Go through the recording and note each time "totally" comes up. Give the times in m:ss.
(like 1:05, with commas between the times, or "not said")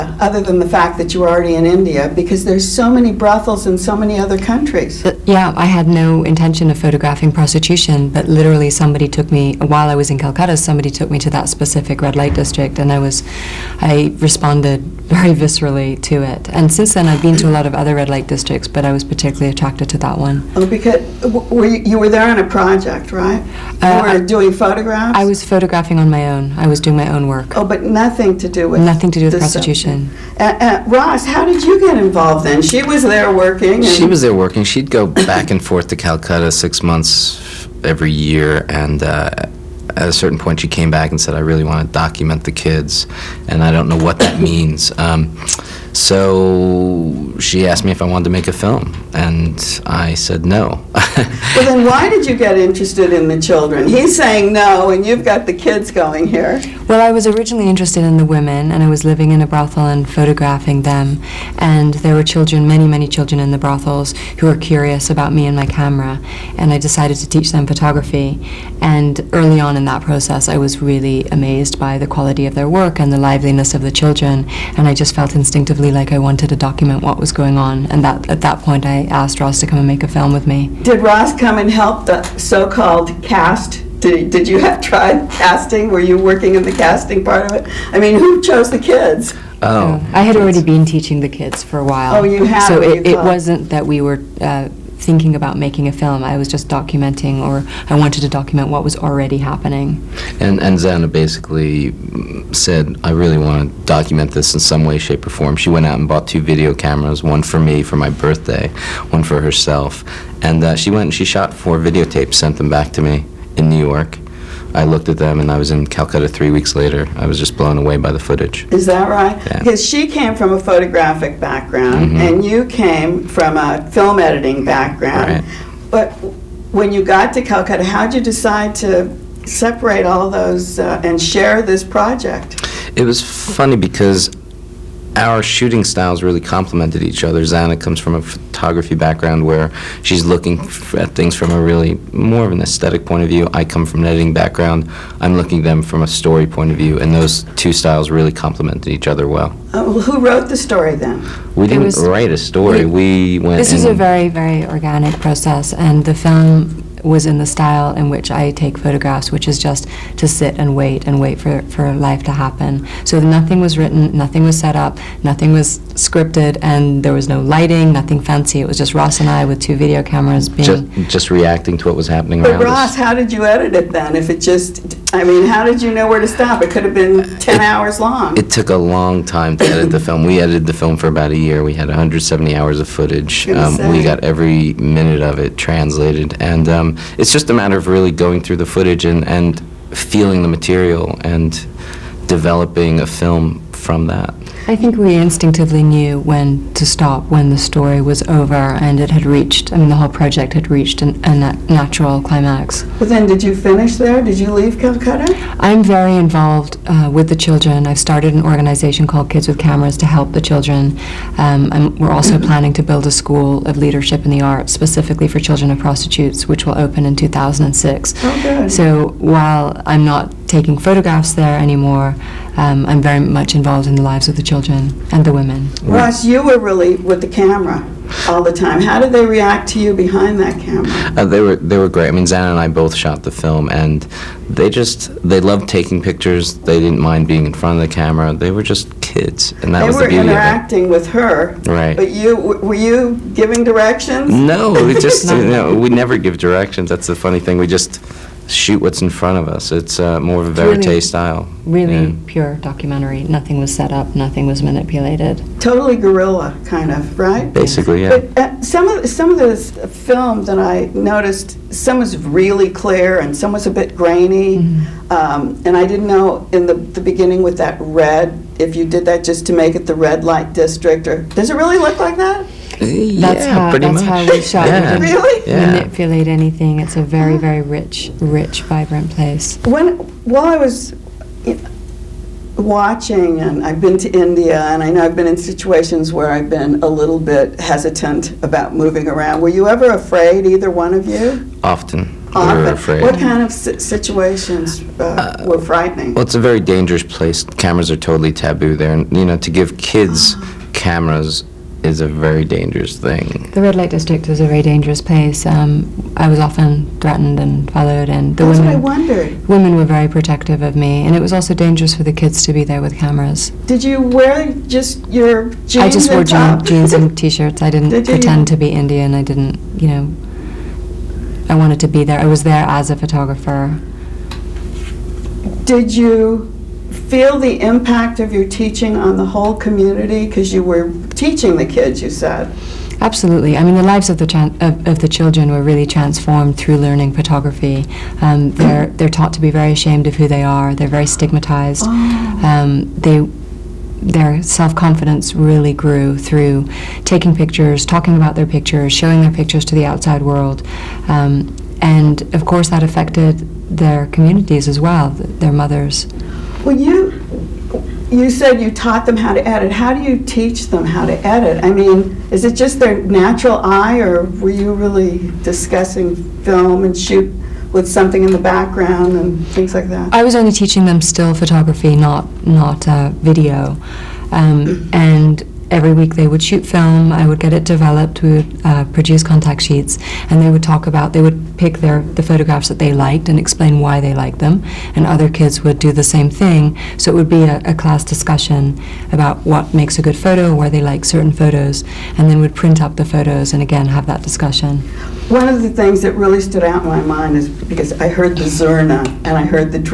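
4:15, 4:57.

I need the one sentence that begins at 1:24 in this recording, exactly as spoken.
Did, did you have tried casting?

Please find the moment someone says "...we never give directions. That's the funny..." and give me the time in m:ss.
4:05.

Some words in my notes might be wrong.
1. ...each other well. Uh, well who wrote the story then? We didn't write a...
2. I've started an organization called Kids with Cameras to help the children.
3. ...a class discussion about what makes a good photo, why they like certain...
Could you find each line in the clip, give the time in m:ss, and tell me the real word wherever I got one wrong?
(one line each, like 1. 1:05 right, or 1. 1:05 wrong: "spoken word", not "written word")
1. 2:28 right
2. 3:27 right
3. 6:27 right.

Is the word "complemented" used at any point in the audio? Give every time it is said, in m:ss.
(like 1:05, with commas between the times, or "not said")
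2:16, 2:28.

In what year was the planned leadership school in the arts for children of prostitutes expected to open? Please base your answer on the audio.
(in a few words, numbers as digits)
2006.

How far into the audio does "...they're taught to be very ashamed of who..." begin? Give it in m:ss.
5:38.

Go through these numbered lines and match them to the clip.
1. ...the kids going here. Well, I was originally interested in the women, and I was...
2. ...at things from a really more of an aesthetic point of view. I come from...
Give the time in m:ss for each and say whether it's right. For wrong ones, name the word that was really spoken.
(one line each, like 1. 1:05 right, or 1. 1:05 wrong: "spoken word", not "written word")
1. 0:55 right
2. 2:20 right.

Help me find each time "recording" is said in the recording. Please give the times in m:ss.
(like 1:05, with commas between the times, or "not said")
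not said.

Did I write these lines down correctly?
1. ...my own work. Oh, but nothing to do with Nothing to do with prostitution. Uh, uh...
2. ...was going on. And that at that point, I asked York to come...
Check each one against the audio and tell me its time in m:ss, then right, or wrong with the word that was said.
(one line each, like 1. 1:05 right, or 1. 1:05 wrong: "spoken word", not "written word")
1. 0:26 right
2. 1:17 wrong: "Ross", not "York".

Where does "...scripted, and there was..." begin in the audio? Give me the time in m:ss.
2:45.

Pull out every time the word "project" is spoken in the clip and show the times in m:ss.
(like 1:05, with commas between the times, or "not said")
0:22, 2:11, 3:20.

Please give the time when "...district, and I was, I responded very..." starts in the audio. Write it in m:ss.
0:12.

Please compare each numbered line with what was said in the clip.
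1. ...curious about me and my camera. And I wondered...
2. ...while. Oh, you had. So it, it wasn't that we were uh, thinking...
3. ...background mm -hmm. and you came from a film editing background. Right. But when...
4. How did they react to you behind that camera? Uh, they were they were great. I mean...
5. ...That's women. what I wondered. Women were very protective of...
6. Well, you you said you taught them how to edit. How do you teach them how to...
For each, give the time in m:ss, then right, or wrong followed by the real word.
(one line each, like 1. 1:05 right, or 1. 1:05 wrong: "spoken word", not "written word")
1. 1:04 wrong: "decided", not "wondered"
2. 1:31 right
3. 2:01 right
4. 3:48 right
5. 5:08 right
6. 5:56 right.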